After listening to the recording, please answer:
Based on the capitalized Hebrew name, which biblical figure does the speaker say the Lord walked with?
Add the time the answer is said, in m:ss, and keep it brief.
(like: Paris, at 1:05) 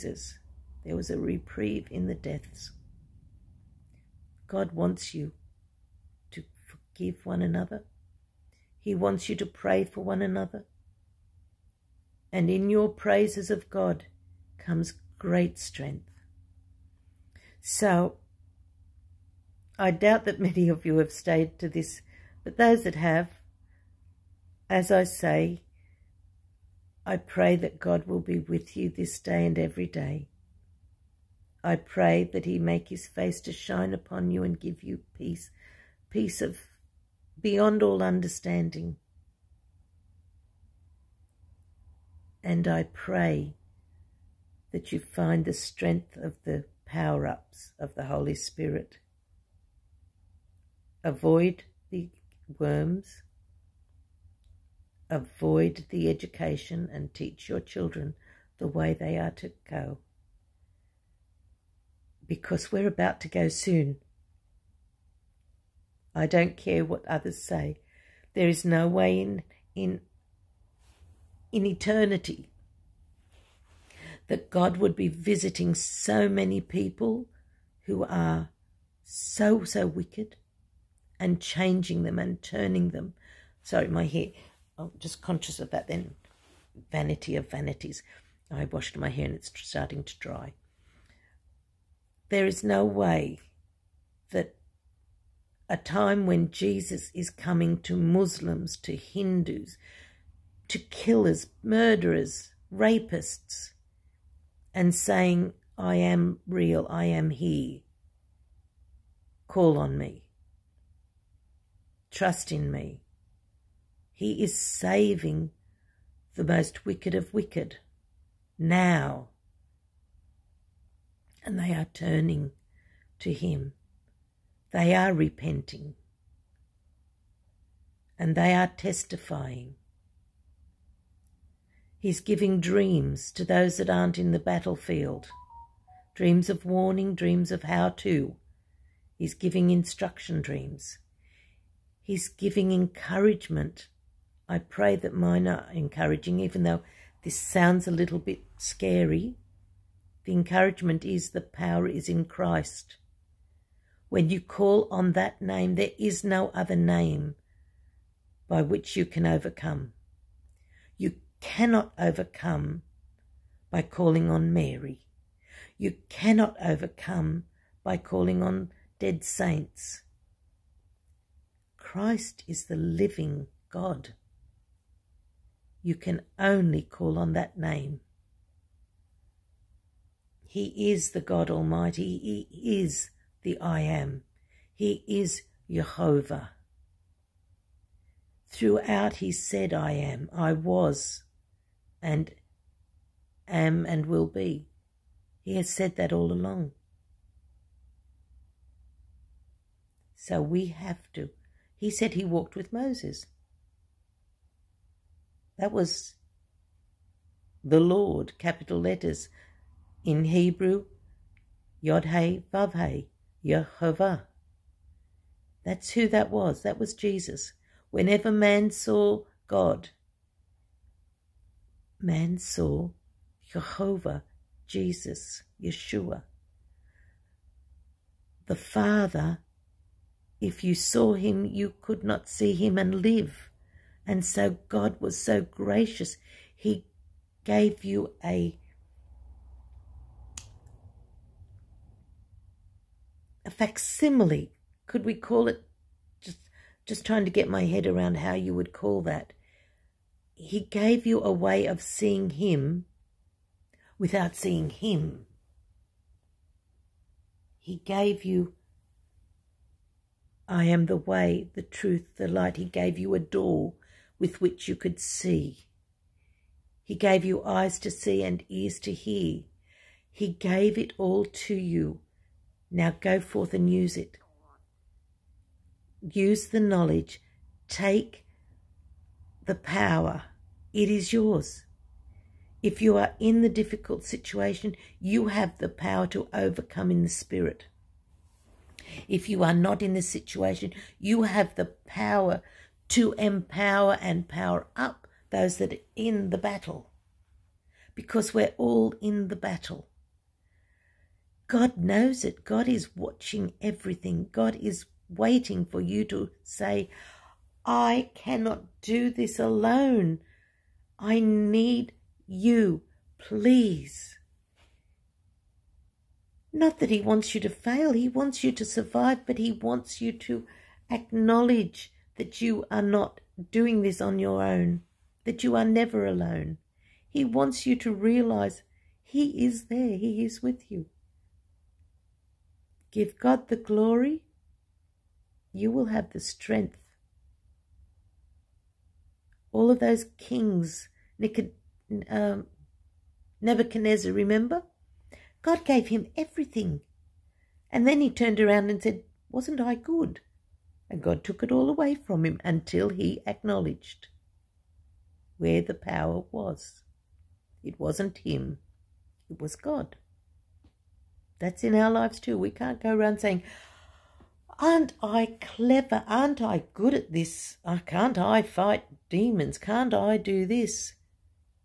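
Moses, at 3:22.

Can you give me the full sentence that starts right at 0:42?
And I pray that you find the strength of the power ups of the Holy Spirit.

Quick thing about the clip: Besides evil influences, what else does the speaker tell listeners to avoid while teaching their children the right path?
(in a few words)
the education.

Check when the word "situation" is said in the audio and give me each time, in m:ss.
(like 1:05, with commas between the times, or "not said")
4:44, 4:50.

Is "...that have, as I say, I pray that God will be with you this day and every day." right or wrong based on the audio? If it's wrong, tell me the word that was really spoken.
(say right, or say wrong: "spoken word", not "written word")
right.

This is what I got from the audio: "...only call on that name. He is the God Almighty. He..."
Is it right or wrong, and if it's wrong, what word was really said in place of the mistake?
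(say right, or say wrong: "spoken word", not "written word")
right.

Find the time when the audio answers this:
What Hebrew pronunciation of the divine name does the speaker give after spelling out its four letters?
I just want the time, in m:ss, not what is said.
3:33.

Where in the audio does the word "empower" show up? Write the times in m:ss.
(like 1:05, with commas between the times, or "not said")
4:53.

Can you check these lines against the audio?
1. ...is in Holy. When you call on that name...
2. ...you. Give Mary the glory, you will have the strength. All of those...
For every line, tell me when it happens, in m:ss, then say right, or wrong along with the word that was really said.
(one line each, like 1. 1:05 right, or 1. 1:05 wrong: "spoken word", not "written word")
1. 2:31 wrong: "Christ", not "Holy"
2. 5:30 wrong: "God", not "Mary".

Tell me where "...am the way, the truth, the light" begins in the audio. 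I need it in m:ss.
4:20.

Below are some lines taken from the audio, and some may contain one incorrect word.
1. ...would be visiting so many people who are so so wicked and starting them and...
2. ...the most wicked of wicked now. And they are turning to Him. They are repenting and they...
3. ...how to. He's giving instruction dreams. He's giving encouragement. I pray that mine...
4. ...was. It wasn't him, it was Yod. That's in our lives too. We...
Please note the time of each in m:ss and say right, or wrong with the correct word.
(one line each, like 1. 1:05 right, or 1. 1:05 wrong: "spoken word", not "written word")
1. 1:14 wrong: "changing", not "starting"
2. 1:56 right
3. 2:17 right
4. 5:56 wrong: "God", not "Yod".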